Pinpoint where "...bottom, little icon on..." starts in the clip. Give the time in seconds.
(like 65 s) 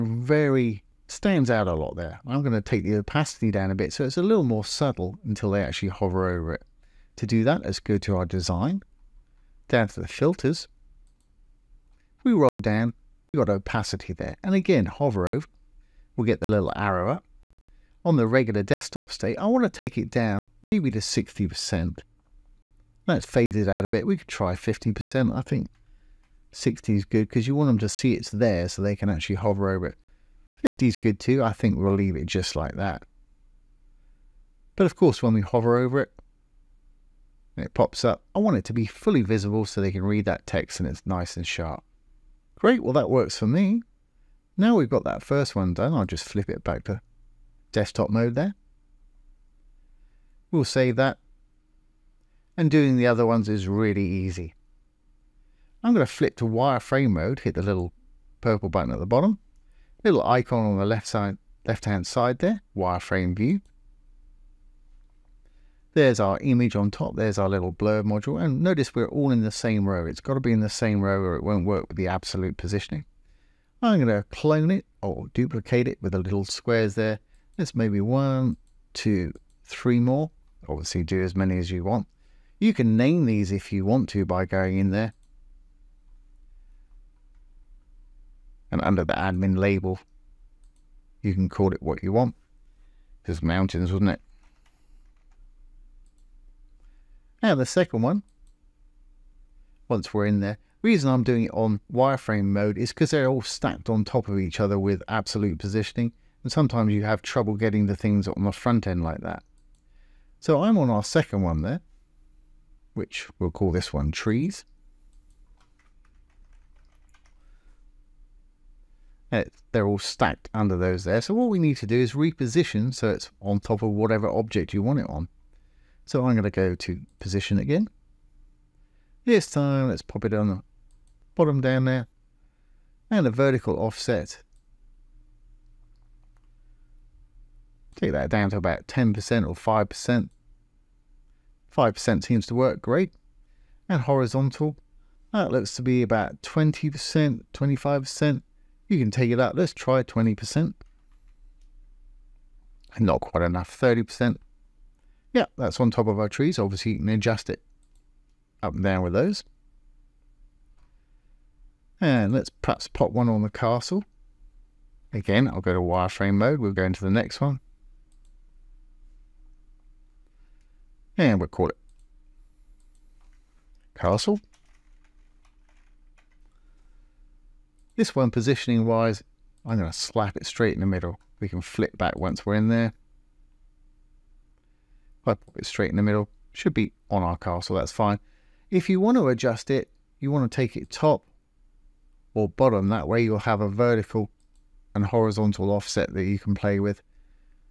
59 s.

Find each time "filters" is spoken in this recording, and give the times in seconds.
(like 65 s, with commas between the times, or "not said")
10 s.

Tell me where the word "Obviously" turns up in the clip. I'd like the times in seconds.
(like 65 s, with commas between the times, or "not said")
80 s, 156 s.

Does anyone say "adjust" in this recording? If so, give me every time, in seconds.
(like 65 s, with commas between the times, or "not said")
157 s, 189 s.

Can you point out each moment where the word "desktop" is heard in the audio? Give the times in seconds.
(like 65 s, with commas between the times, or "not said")
18 s, 47 s.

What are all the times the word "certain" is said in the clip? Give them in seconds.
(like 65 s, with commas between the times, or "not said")
not said.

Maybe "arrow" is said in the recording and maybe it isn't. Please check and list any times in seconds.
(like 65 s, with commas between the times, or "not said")
16 s.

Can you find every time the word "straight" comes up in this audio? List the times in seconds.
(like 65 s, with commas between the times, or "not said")
180 s, 185 s.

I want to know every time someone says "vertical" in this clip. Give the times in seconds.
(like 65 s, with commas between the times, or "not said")
133 s, 193 s.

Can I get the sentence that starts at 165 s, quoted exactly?
Again, I'll go to wireframe mode.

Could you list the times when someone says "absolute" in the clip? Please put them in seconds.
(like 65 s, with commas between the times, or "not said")
72 s, 105 s.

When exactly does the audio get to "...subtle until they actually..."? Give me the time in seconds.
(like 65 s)
4 s.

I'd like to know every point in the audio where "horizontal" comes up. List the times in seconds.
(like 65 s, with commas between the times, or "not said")
144 s, 195 s.